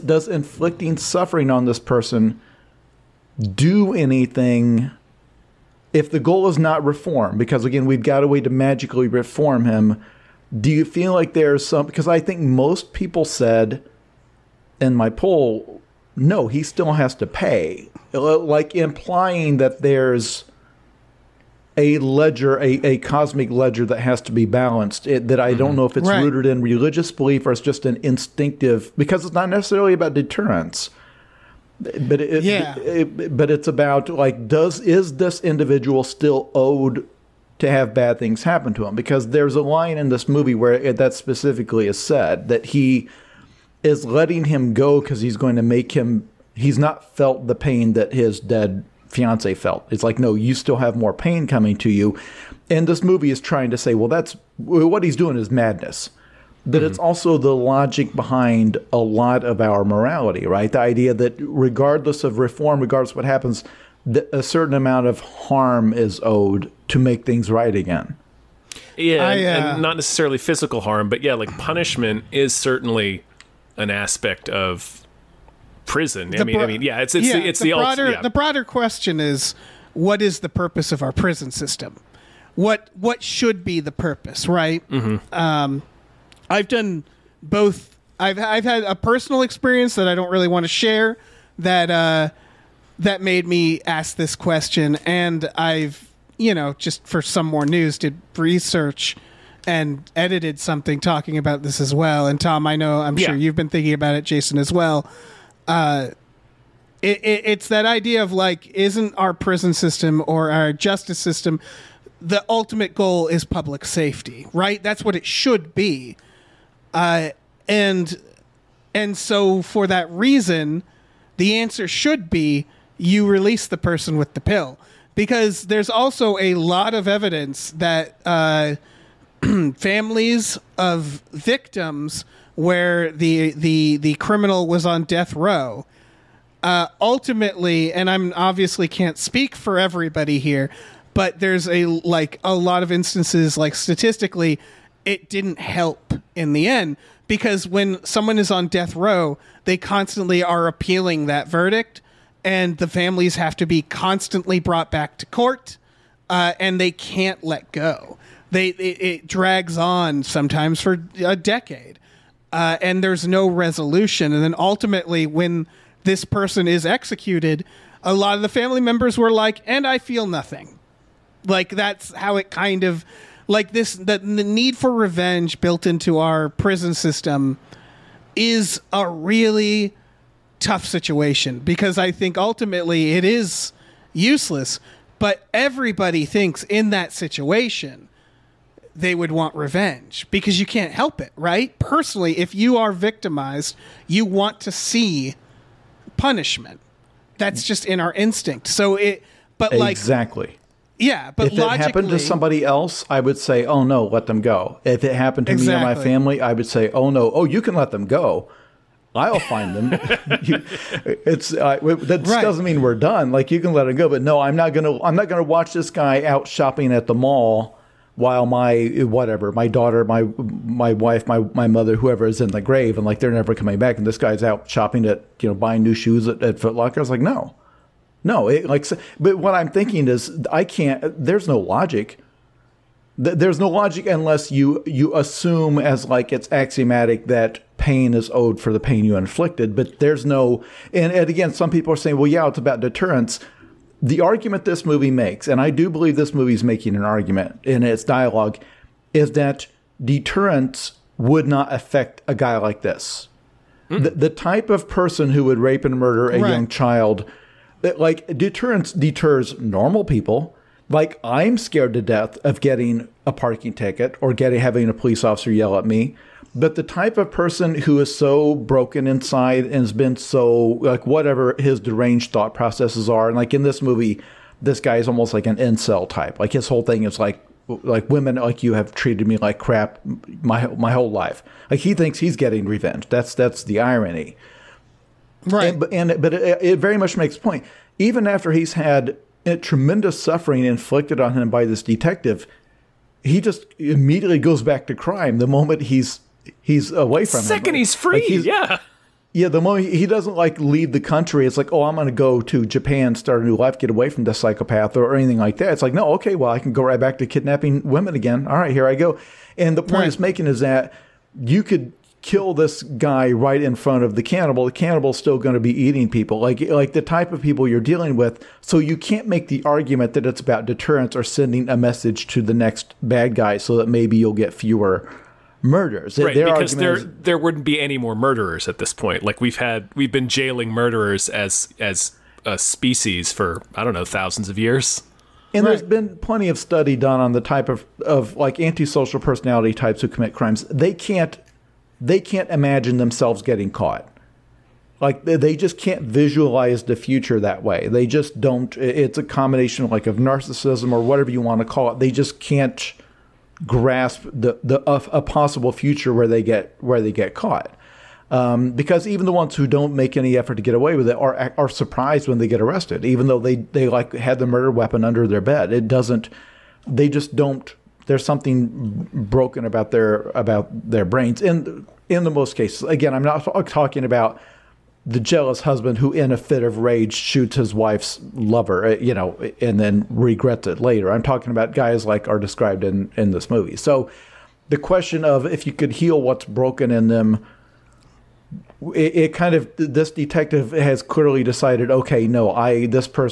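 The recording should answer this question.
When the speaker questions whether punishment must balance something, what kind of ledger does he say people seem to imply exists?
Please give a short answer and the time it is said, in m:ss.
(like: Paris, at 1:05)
cosmic ledger, at 0:22.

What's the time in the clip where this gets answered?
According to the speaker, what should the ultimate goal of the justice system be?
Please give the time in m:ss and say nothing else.
1:53.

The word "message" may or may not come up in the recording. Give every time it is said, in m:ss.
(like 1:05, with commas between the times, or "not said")
5:21.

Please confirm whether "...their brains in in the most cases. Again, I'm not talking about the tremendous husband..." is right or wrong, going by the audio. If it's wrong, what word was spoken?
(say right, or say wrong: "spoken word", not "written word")
wrong: "jealous", not "tremendous".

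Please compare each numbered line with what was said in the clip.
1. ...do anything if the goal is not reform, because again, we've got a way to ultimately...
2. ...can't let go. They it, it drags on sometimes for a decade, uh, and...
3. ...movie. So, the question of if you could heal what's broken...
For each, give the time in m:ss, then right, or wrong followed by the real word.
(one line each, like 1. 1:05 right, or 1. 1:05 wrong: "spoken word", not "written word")
1. 0:03 wrong: "magically", not "ultimately"
2. 2:36 right
3. 6:23 right.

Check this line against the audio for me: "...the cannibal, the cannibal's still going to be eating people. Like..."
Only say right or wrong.
right.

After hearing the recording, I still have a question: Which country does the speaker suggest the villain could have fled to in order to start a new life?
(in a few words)
Japan.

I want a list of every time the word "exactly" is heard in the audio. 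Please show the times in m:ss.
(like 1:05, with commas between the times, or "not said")
3:19, 3:25.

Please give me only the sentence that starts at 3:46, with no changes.
I was like, no, no, it like, but what I'm thinking is, I can't.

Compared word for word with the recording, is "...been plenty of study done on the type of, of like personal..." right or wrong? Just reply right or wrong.
wrong.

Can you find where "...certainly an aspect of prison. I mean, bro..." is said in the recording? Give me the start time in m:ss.
1:12.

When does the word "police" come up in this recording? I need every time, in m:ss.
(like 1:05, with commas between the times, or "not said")
4:24.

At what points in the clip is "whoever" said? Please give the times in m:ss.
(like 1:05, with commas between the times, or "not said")
3:41.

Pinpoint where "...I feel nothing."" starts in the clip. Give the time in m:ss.
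2:49.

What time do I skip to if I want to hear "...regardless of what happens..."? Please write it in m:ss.
1:02.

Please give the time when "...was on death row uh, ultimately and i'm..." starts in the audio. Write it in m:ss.
2:14.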